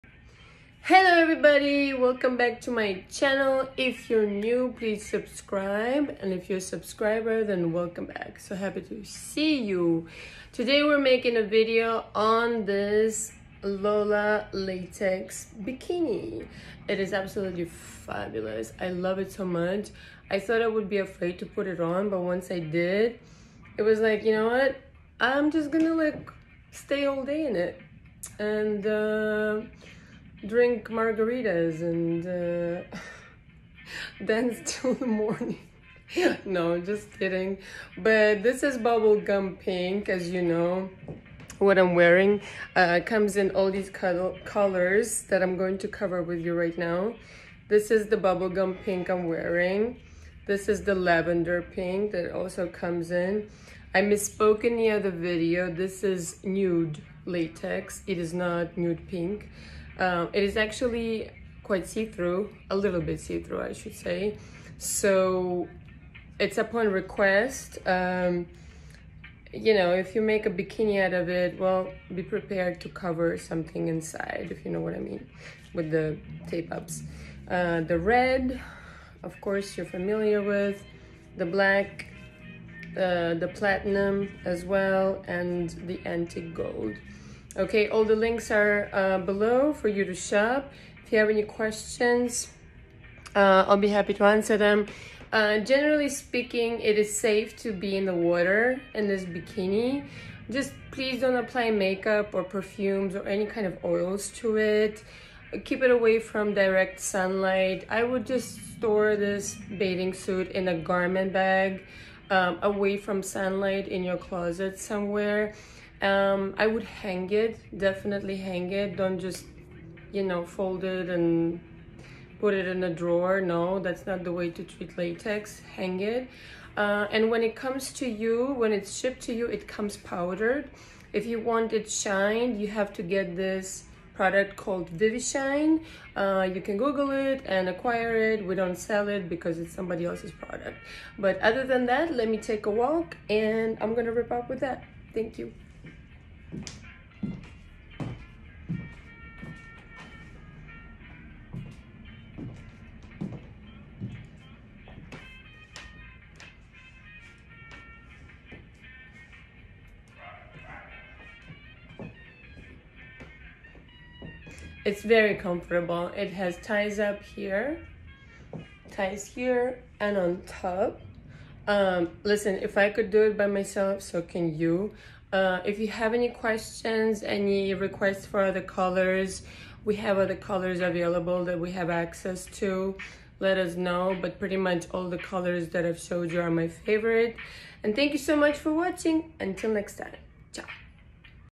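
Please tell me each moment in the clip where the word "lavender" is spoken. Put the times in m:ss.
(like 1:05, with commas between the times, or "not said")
0:50.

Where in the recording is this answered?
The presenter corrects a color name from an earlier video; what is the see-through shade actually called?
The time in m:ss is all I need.
0:56.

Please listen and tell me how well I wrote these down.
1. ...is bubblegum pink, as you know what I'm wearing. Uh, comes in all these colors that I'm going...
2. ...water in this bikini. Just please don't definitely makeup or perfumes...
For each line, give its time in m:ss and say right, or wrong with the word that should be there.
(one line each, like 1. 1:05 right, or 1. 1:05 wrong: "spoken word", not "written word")
1. 0:38 right
2. 1:38 wrong: "apply", not "definitely".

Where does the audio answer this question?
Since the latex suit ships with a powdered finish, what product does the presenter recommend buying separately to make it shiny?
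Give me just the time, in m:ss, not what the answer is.
2:14.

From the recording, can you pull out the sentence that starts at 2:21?
But other than that, let me take a walk and I'm gonna rip up with that.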